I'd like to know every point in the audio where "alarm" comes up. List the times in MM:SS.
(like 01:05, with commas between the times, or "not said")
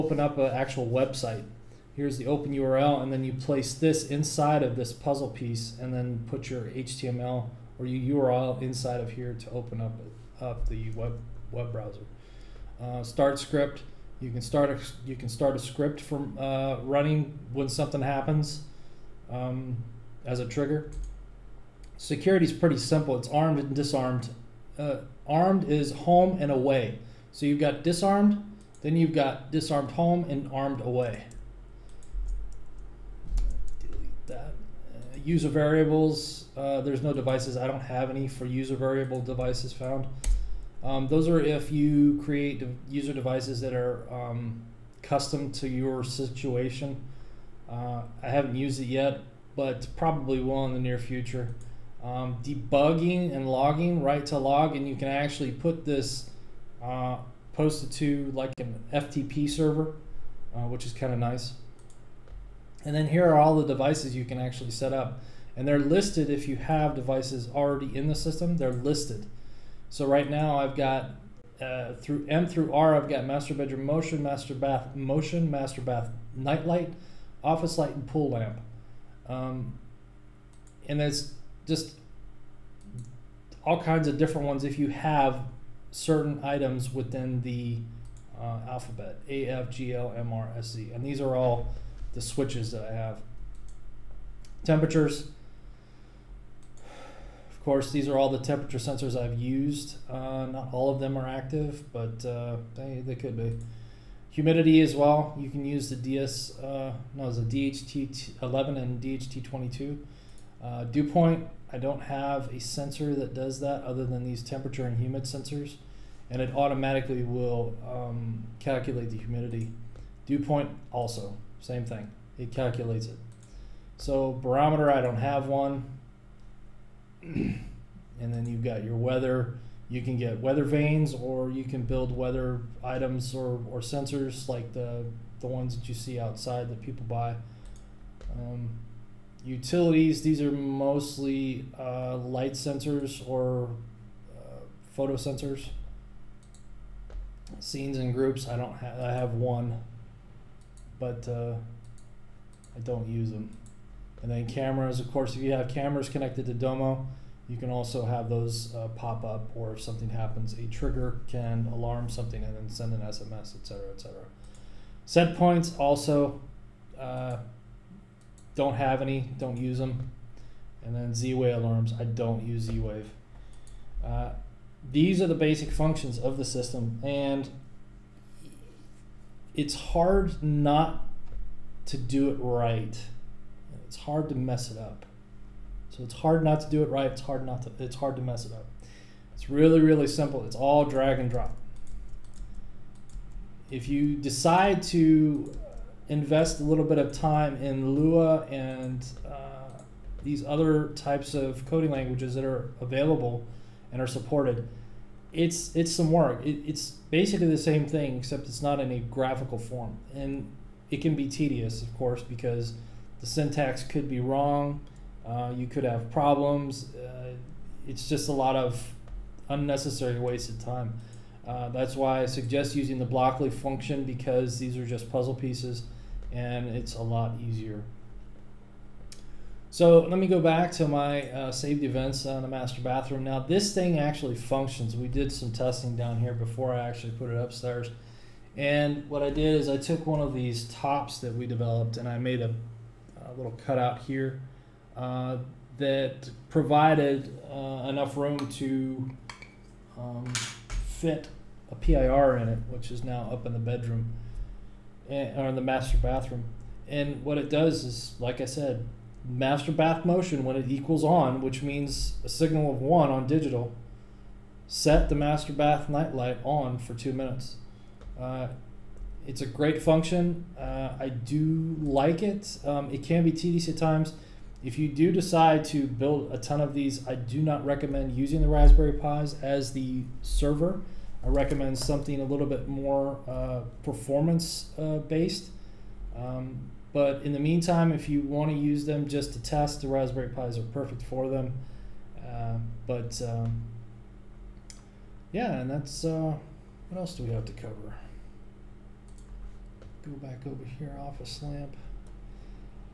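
02:41, 02:51.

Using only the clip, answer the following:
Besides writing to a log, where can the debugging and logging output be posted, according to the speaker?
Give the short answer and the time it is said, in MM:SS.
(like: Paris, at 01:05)
FTP server, at 00:58.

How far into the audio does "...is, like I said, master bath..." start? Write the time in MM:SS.
04:17.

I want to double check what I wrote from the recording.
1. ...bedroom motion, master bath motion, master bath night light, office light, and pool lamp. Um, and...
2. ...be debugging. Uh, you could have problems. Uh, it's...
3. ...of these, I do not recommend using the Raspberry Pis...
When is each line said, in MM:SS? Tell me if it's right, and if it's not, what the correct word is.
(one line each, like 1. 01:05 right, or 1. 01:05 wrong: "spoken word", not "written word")
1. 01:13 right
2. 03:34 wrong: "wrong", not "debugging"
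3. 04:36 right.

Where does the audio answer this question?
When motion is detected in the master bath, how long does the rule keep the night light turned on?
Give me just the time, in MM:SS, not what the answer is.
04:26.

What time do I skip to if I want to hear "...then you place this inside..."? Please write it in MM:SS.
00:03.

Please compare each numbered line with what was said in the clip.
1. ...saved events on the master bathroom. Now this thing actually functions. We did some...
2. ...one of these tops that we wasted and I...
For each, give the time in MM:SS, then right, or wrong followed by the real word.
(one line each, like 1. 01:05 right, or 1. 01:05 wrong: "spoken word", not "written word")
1. 03:51 right
2. 04:00 wrong: "developed", not "wasted".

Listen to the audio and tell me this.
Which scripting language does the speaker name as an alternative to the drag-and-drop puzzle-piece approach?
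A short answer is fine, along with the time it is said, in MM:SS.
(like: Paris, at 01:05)
Lua, at 03:17.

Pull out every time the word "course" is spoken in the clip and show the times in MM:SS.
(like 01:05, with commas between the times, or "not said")
01:37, 02:35, 03:31.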